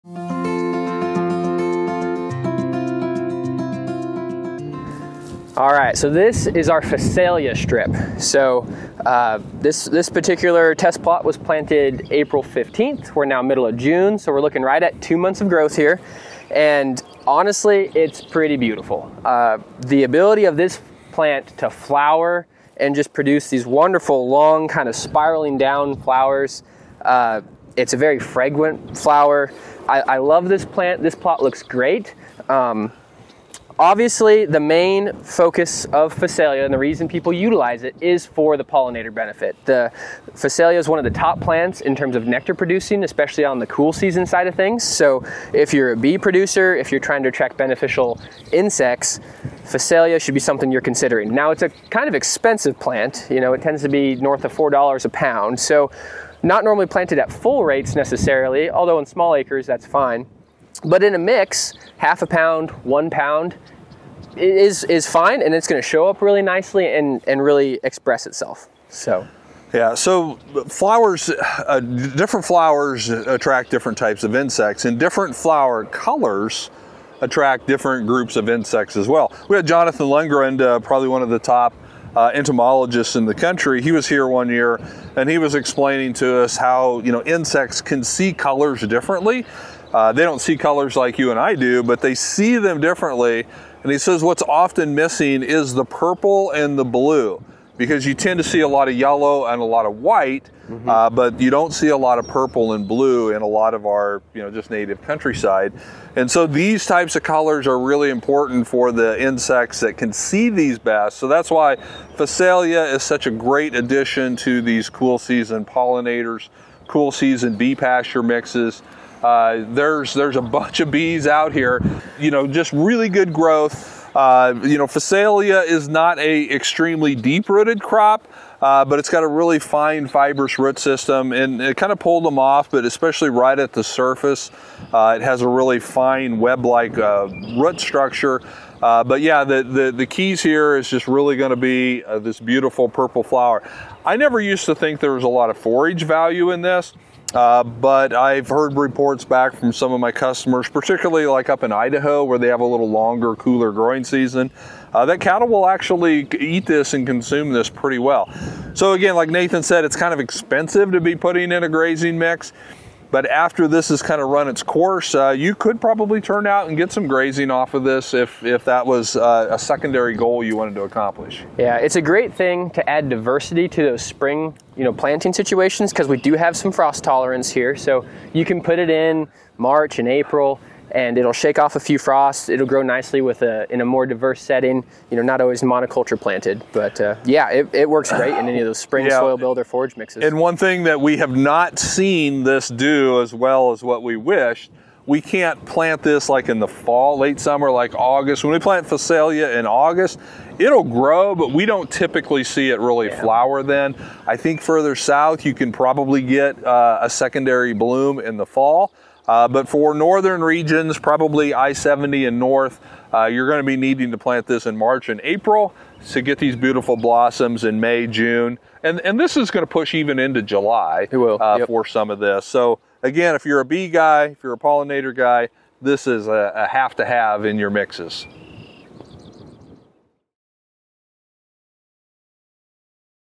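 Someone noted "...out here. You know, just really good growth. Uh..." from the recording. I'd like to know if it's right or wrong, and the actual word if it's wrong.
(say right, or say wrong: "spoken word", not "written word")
right.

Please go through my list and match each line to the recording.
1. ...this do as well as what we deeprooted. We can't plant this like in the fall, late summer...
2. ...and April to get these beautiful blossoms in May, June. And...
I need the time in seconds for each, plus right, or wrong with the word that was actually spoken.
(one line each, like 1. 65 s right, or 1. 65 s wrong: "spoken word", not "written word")
1. 192 s wrong: "wished", not "deeprooted"
2. 215 s right.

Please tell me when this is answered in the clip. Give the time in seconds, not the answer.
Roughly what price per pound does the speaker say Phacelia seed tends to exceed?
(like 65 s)
54 s.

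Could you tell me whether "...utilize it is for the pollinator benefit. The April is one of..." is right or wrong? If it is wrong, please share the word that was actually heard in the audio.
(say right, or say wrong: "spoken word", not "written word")
wrong: "Phacelia", not "April".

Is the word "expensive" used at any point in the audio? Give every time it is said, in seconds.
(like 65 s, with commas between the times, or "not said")
52 s, 160 s.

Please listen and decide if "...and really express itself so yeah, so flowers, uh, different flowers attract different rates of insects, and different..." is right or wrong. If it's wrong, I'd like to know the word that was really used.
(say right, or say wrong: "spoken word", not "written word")
wrong: "types", not "rates".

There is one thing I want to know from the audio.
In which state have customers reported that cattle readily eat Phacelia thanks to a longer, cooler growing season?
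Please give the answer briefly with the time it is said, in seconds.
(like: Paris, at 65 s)
Idaho, at 151 s.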